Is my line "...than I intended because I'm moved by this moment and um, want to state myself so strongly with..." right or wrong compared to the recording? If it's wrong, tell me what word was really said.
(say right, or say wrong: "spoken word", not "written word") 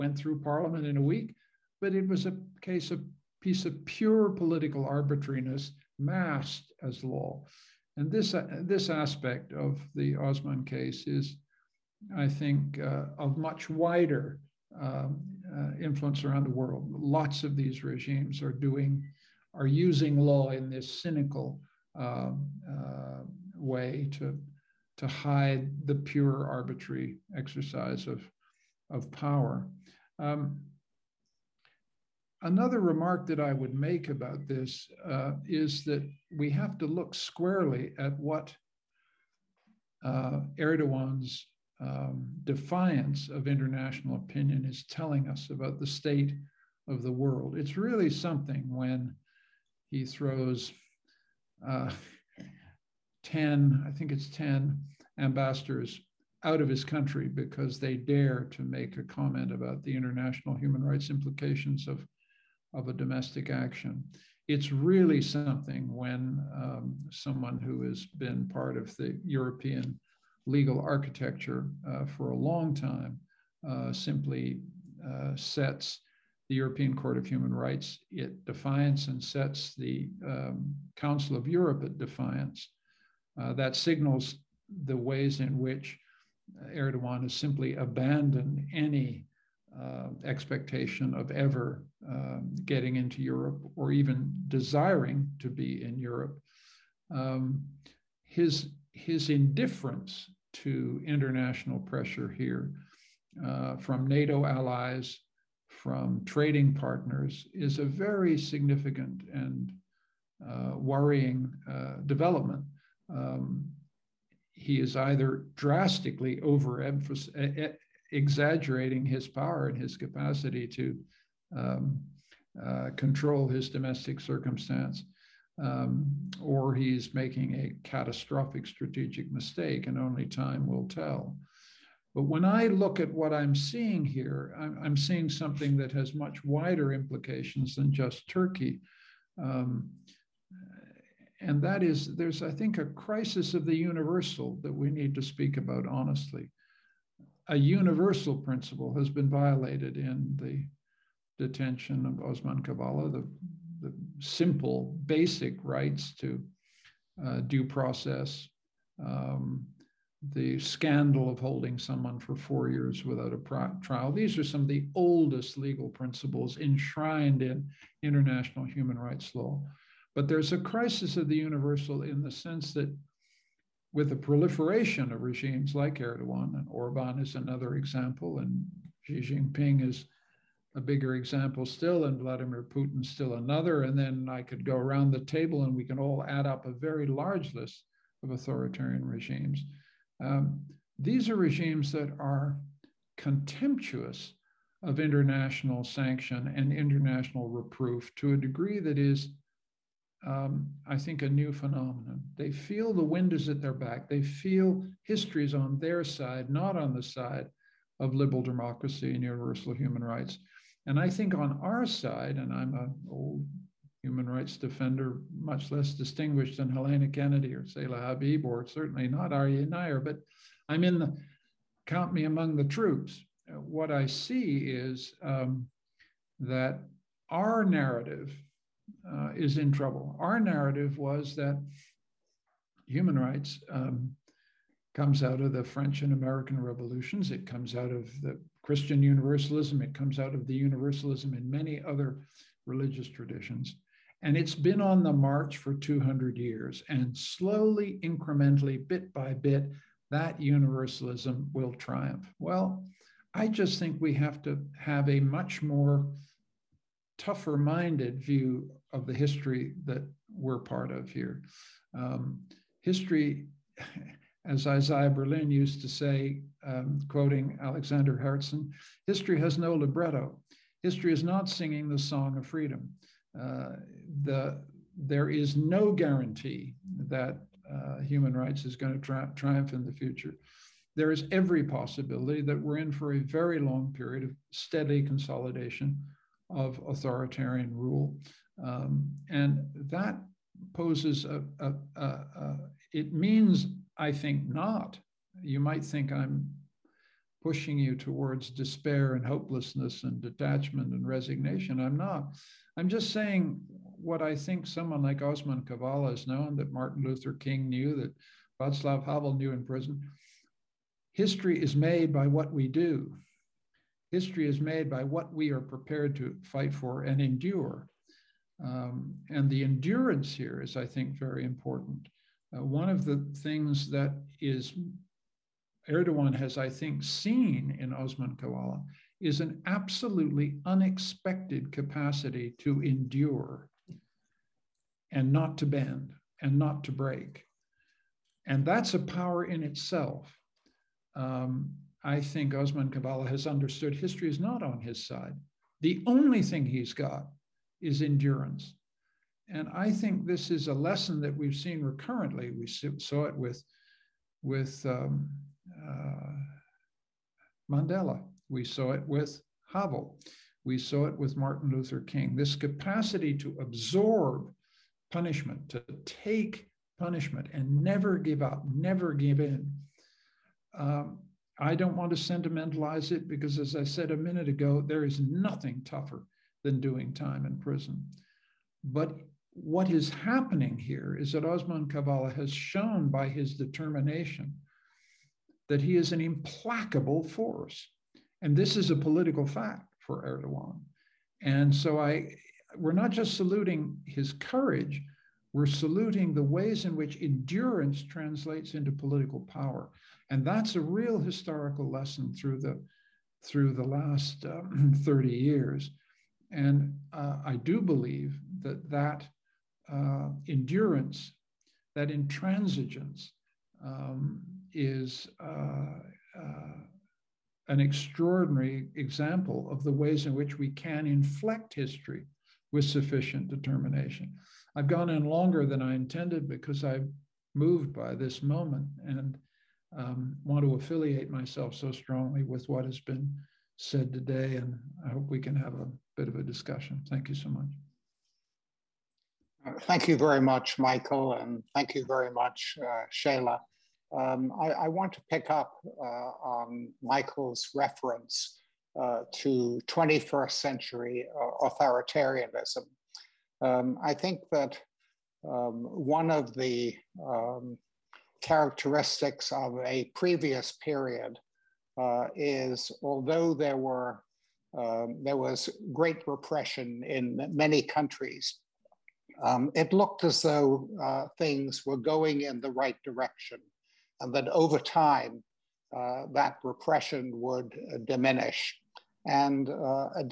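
wrong: "affiliate", not "state".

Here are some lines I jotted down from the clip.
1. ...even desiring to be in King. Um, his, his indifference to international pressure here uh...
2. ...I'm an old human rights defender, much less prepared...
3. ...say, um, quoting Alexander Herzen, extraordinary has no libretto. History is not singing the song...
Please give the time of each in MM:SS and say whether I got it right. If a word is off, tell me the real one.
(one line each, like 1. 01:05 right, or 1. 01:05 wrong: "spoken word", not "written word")
1. 01:33 wrong: "Europe", not "King"
2. 03:32 wrong: "distinguished", not "prepared"
3. 04:25 wrong: "history", not "extraordinary".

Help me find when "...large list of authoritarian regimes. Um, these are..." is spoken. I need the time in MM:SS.
03:07.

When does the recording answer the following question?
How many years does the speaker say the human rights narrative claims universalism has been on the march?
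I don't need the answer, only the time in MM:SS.
04:05.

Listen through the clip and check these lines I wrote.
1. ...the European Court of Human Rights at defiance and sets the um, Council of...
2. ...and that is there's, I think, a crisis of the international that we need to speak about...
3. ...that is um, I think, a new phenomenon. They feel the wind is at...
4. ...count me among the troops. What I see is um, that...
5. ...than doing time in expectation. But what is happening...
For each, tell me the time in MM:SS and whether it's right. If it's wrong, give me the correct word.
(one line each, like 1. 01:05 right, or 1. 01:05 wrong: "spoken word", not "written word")
1. 01:16 right
2. 02:21 wrong: "universal", not "international"
3. 03:18 right
4. 03:41 right
5. 06:16 wrong: "prison", not "expectation".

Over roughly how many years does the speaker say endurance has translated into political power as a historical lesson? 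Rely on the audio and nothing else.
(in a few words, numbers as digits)
30.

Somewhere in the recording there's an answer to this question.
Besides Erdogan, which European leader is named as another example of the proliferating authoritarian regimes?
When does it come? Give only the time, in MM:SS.
02:56.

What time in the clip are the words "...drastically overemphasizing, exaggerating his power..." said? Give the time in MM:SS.
01:55.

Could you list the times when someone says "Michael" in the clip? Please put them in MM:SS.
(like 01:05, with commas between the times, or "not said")
07:20, 07:27.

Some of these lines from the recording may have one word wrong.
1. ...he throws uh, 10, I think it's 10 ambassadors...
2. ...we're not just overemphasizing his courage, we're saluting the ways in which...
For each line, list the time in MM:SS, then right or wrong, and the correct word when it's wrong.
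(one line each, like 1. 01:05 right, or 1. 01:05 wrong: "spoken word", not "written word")
1. 00:49 right
2. 06:32 wrong: "saluting", not "overemphasizing".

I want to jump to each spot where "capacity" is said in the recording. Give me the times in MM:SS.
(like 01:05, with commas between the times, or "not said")
01:59, 05:31, 06:02.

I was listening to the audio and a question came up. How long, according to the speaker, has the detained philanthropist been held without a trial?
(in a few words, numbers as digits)
four years.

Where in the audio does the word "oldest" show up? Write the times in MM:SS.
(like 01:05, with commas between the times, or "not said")
02:44.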